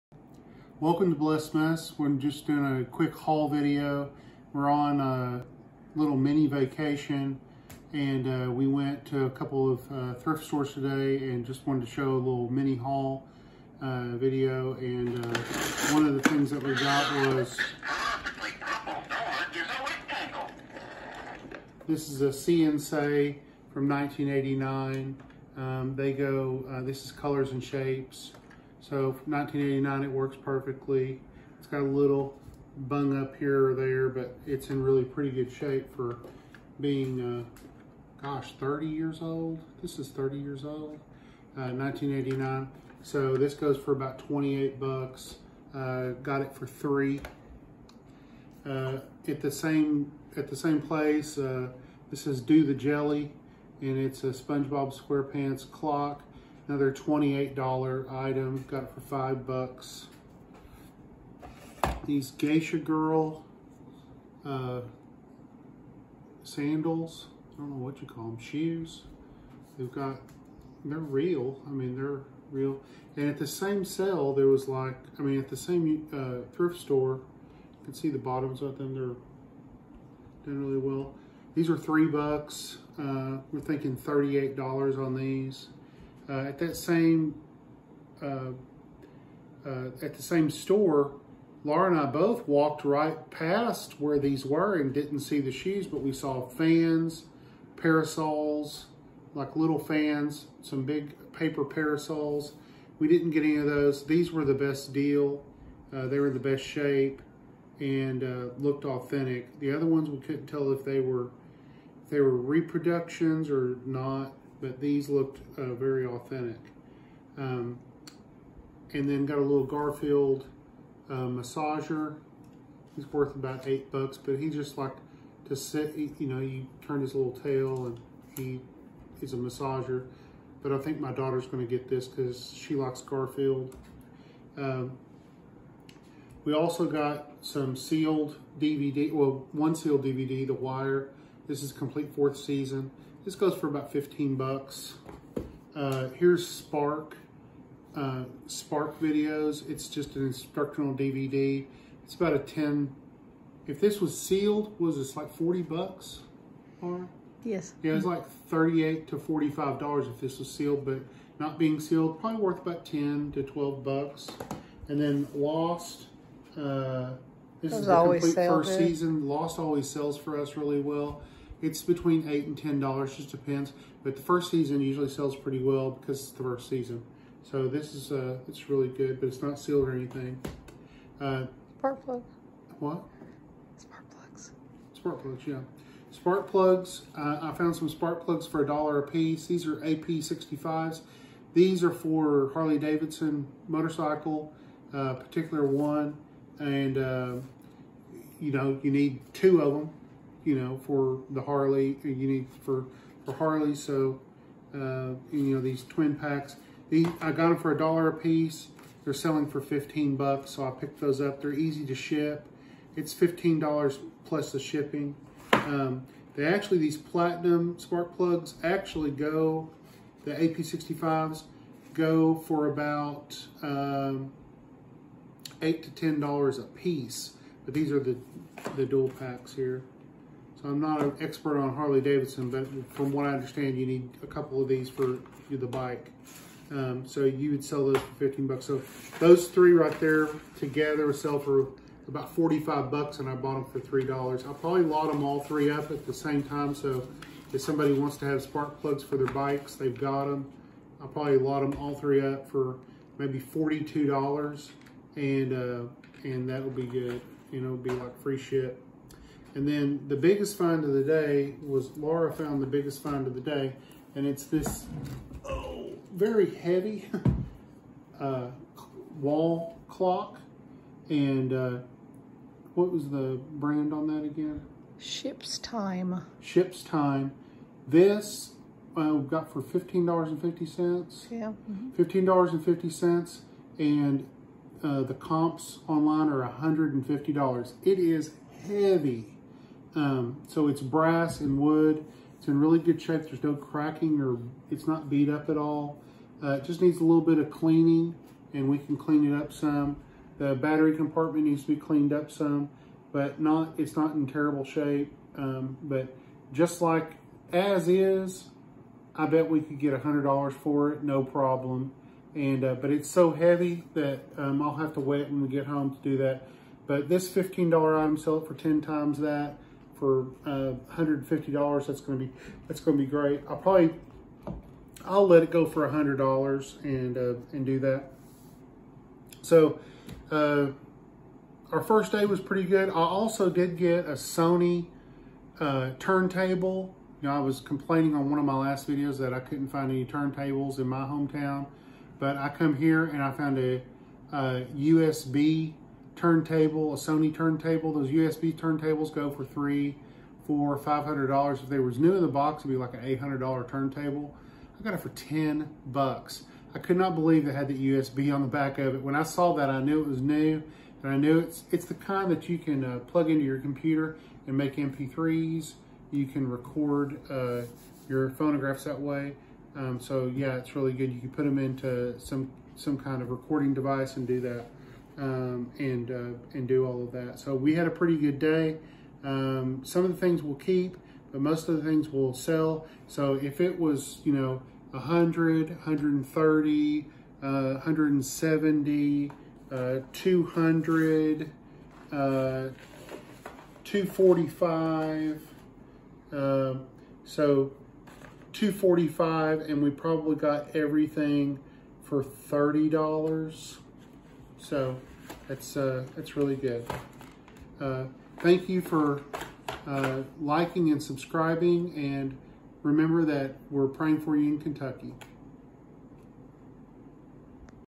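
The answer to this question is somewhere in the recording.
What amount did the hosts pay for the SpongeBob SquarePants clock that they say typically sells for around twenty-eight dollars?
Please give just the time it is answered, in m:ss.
0:59.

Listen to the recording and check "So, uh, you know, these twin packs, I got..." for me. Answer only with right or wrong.
right.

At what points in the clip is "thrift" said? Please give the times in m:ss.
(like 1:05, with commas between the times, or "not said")
0:10, 1:16.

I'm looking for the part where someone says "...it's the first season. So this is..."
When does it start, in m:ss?
2:56.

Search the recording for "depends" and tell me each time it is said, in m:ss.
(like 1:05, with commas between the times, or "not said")
2:53.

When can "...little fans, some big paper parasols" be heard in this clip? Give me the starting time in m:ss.
1:39.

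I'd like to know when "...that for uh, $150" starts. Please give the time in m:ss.
5:19.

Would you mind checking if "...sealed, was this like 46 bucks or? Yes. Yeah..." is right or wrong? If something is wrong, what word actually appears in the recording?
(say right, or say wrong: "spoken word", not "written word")
wrong: "40", not "46".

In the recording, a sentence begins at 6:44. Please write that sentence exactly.
So it's, uh, it's really good.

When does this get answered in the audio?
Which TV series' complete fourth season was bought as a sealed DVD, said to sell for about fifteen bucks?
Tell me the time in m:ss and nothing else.
2:20.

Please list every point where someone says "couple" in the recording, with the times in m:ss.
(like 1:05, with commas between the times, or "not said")
0:09, 3:54.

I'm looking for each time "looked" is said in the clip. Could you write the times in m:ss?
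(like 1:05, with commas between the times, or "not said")
1:48, 1:55.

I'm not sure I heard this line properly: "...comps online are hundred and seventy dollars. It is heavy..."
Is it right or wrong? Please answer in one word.
wrong.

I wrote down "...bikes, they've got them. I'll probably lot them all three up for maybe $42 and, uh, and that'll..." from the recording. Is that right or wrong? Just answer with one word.
right.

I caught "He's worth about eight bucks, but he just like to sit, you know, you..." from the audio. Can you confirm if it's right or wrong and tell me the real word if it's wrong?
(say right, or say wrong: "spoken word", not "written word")
right.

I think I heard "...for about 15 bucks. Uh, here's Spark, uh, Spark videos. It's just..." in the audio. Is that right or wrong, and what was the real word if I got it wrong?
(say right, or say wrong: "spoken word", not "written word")
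right.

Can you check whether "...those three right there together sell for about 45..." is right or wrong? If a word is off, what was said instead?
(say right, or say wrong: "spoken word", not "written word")
right.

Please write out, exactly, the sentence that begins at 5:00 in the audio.
The battery compartment needs to be cleaned up some, but not it's not in terrible shape.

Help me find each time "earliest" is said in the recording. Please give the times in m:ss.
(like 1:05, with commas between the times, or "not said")
not said.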